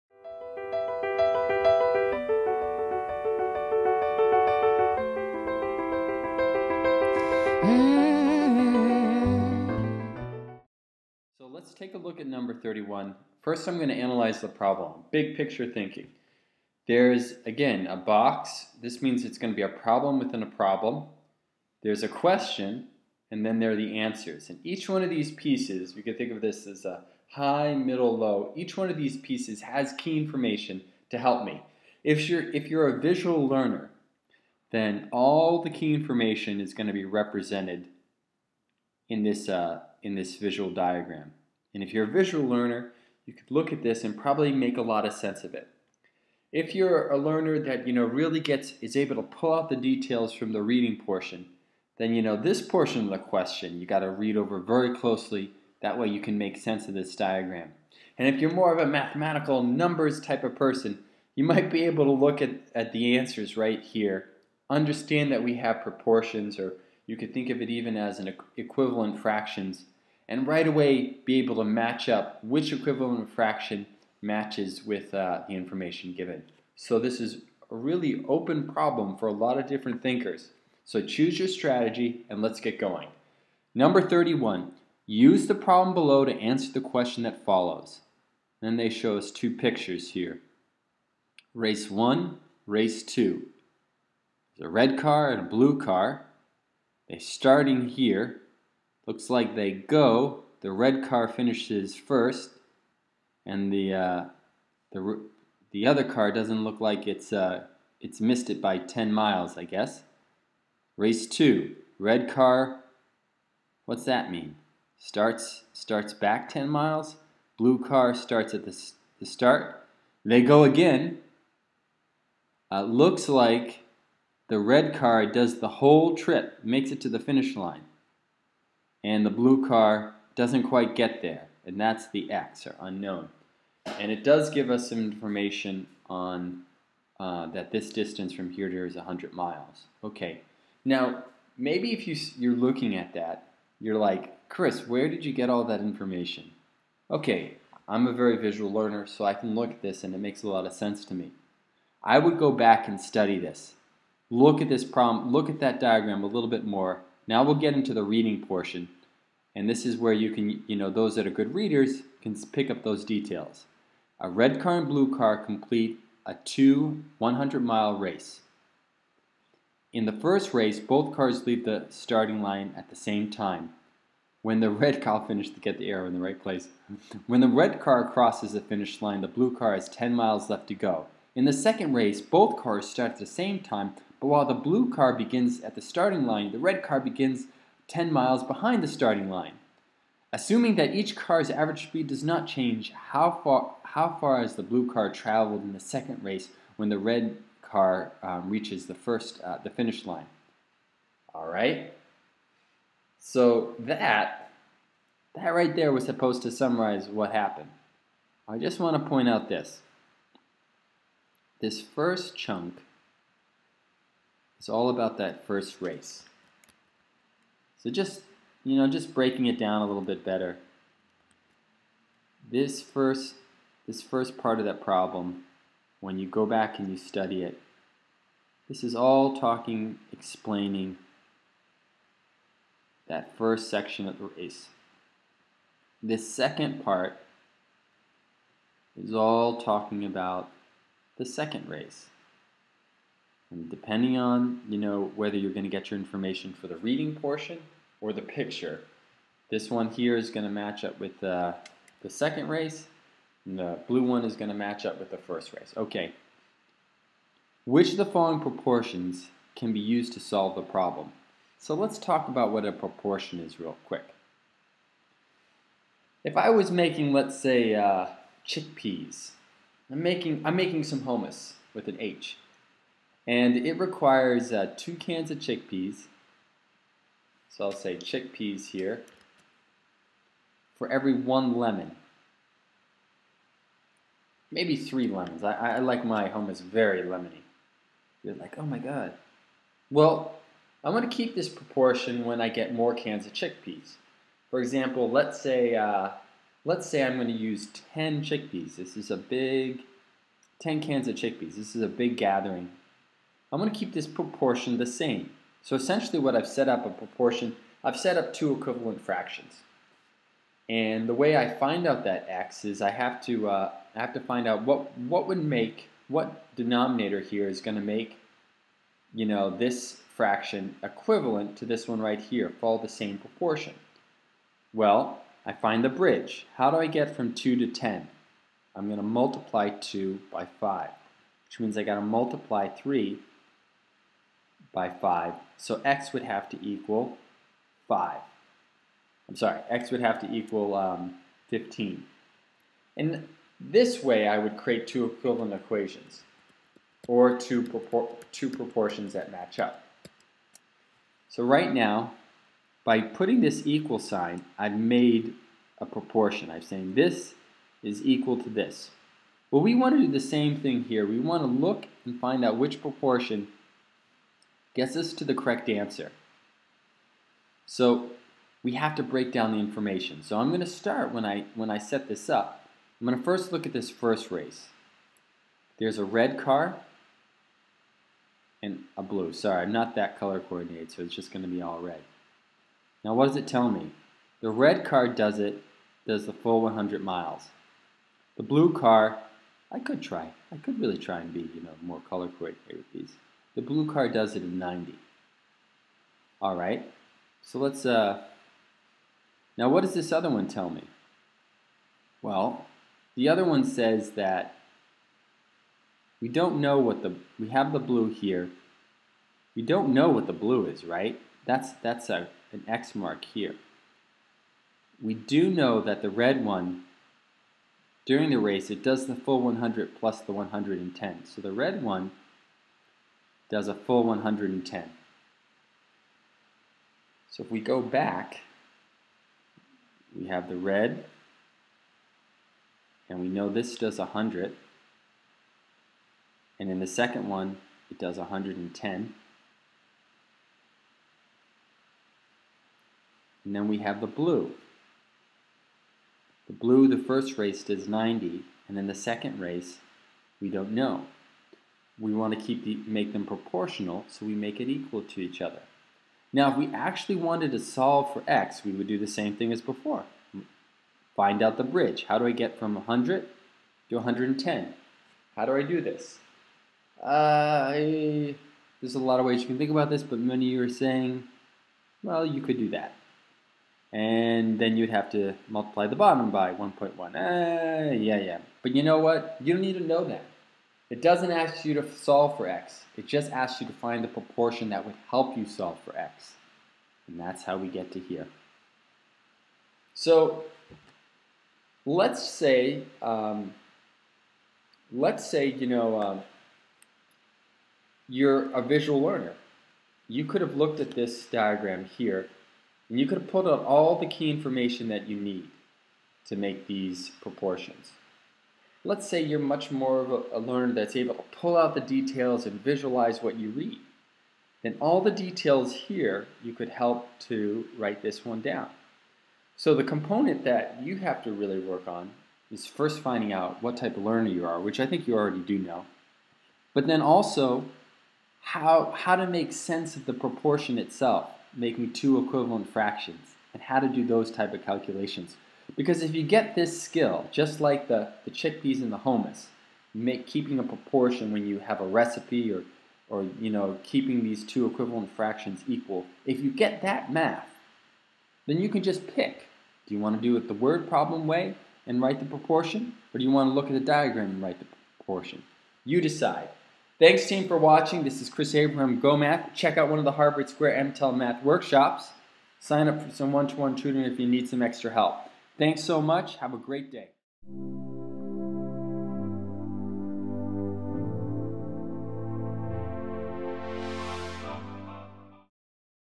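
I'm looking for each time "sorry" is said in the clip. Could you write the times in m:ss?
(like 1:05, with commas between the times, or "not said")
5:39, 6:19.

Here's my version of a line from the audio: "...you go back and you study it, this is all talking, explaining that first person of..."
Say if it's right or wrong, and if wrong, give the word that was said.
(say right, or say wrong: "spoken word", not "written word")
wrong: "section", not "person".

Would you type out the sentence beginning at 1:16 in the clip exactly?
So this is a really open problem for a lot of different thinkers.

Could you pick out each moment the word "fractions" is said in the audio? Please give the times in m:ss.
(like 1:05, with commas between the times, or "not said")
1:09, 1:13, 5:09, 5:20, 8:52, 9:05.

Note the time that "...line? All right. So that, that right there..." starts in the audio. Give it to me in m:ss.
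3:20.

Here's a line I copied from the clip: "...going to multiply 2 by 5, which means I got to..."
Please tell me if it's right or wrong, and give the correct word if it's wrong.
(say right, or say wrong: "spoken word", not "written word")
right.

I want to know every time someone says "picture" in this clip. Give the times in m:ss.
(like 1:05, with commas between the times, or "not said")
0:15, 1:29, 4:08.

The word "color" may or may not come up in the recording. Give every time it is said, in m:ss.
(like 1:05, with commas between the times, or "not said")
6:20, 6:32.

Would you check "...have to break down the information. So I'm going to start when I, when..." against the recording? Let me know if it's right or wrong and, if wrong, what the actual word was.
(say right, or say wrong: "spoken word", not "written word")
right.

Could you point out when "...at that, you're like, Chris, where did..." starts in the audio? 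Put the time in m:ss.
2:22.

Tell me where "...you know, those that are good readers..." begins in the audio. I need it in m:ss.
2:40.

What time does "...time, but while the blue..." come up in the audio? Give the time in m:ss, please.
3:03.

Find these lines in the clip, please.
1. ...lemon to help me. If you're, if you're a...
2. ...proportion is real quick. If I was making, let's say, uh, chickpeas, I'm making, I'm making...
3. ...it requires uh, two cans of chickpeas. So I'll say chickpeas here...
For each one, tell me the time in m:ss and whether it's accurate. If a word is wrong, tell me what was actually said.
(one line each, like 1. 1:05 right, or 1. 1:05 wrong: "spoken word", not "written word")
1. 0:30 wrong: "information", not "lemon"
2. 4:22 right
3. 4:33 right.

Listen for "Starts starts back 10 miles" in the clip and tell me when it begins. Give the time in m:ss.
1:54.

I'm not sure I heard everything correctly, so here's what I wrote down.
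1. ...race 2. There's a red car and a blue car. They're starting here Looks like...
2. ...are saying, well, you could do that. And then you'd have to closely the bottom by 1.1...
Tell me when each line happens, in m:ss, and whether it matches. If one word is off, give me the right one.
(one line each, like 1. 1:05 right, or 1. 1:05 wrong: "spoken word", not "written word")
1. 1:32 right
2. 7:50 wrong: "multiply", not "closely".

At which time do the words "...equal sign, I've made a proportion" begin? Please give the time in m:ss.
5:53.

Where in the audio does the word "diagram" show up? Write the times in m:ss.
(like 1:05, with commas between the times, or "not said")
0:40, 0:57, 2:35, 8:21, 9:13.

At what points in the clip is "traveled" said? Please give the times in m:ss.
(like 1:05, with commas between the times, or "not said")
3:15.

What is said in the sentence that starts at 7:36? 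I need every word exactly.
Now, if we actually wanted to solve for x, we would do the same thing as before.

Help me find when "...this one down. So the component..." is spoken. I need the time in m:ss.
8:38.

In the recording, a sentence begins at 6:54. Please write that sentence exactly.
We do know that the red one, during the race, it does the full 100 plus the 110.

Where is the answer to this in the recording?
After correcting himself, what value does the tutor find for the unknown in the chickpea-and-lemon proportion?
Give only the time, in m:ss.
5:41.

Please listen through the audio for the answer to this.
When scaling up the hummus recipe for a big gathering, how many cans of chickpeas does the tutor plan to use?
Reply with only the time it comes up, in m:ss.
5:00.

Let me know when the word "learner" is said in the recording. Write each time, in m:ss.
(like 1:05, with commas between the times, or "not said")
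0:33, 0:42, 0:47, 2:28, 8:19, 8:30, 8:44.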